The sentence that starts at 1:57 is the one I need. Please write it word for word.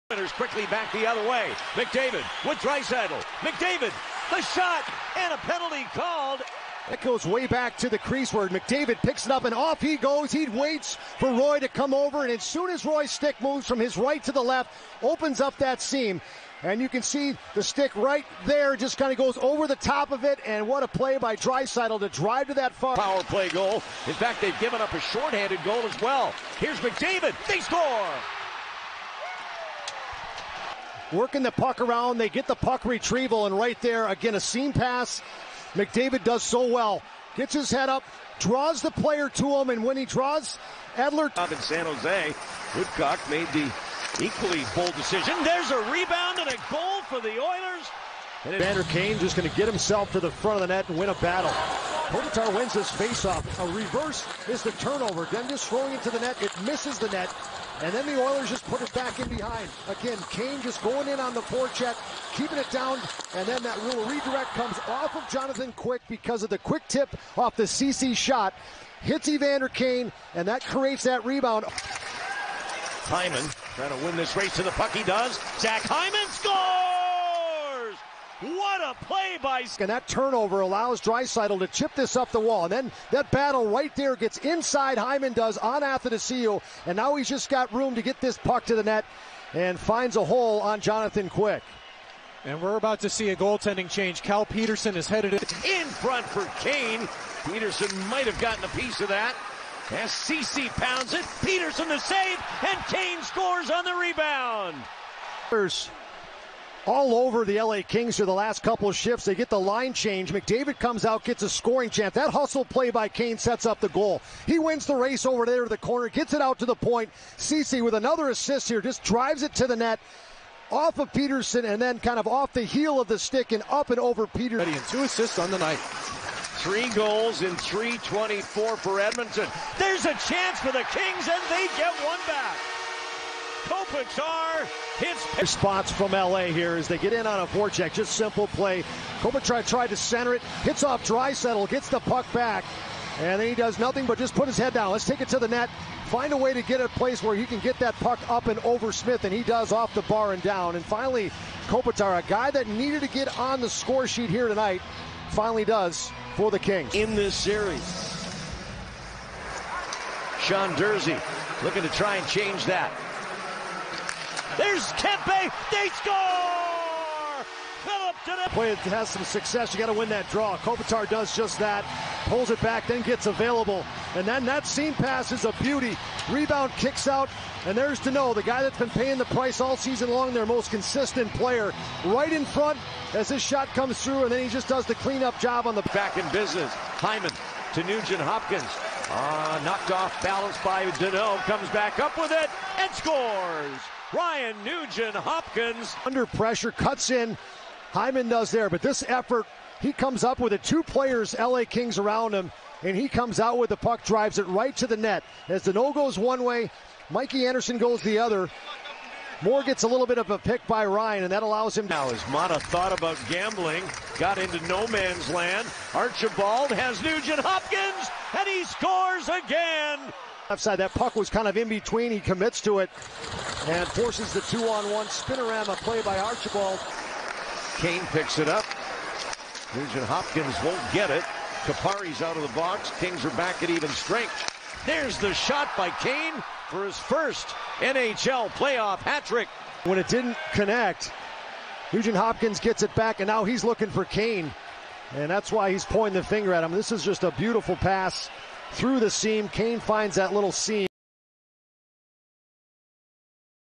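Ceci with another assist here, just drives it to the net.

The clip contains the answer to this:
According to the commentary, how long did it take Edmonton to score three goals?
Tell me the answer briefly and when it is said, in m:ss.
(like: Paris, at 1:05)
3:24, at 2:07.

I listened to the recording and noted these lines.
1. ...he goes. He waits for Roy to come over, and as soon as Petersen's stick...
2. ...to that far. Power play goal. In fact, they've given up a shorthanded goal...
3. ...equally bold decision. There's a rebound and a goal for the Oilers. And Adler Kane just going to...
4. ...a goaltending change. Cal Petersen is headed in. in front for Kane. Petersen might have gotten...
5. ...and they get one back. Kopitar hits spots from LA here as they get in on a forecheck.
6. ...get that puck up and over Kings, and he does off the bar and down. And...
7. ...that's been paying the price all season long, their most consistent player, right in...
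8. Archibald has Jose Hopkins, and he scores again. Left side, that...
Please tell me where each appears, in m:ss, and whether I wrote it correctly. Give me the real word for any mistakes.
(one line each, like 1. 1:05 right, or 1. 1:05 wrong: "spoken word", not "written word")
1. 0:09 wrong: "Roy", not "Petersen"
2. 0:22 right
3. 0:44 wrong: "Vander", not "Adler"
4. 1:33 right
5. 2:11 right
6. 2:27 wrong: "Smith", not "Kings"
7. 2:58 right
8. 3:35 wrong: "Nugent", not "Jose".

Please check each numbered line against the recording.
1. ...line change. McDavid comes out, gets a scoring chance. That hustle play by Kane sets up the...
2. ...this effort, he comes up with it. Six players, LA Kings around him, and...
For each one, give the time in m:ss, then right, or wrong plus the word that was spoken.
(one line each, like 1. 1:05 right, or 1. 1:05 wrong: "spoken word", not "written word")
1. 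1:49 right
2. 3:18 wrong: "Two", not "Six".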